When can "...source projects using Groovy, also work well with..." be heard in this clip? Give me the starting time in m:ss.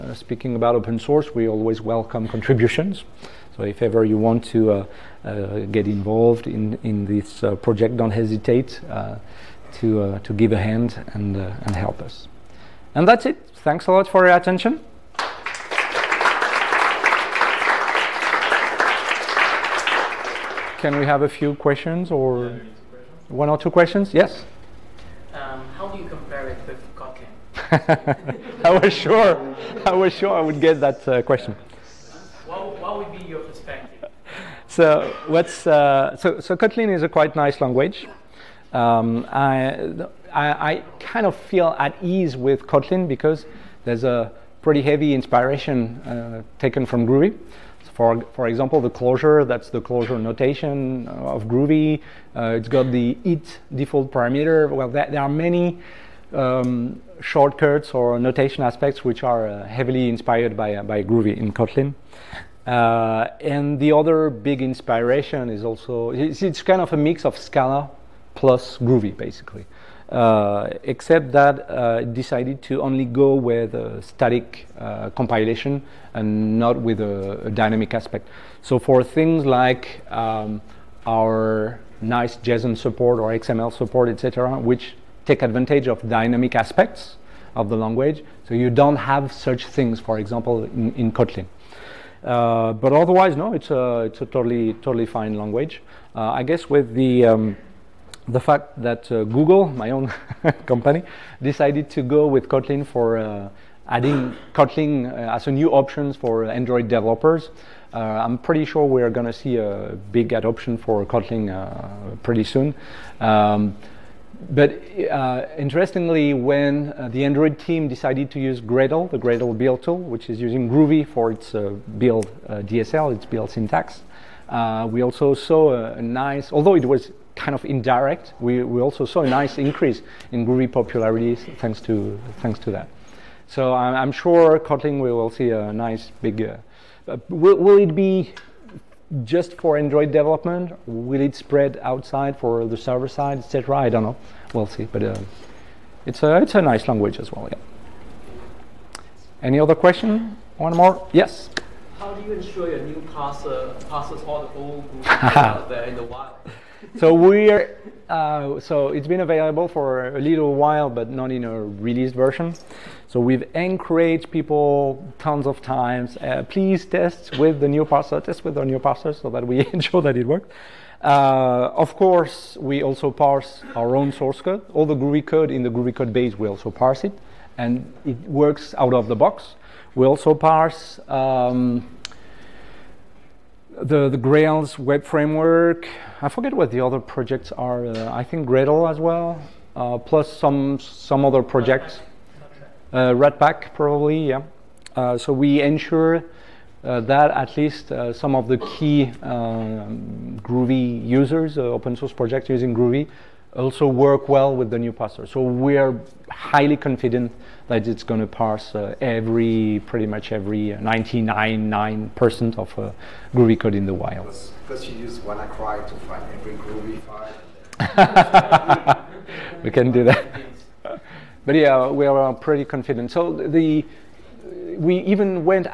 3:21.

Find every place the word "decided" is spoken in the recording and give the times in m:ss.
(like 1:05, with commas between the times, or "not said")
1:12, 1:41, 1:57.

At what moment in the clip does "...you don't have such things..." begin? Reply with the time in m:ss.
1:28.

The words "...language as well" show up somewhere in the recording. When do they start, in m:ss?
2:26.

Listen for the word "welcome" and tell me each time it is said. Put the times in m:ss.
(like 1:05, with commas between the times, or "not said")
0:01.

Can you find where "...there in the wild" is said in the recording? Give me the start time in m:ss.
2:35.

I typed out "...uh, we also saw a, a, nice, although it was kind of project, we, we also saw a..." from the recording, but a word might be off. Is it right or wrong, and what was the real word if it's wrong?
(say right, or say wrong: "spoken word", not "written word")
wrong: "indirect", not "project".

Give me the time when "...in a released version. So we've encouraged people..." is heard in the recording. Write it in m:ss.
2:41.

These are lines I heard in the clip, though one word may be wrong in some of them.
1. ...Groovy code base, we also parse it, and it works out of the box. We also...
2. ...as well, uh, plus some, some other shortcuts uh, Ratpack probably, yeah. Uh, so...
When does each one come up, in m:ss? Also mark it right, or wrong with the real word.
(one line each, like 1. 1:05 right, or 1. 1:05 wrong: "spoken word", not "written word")
1. 2:55 right
2. 3:08 wrong: "projects", not "shortcuts".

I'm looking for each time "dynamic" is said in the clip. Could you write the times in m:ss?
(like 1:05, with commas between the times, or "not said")
1:17, 1:26.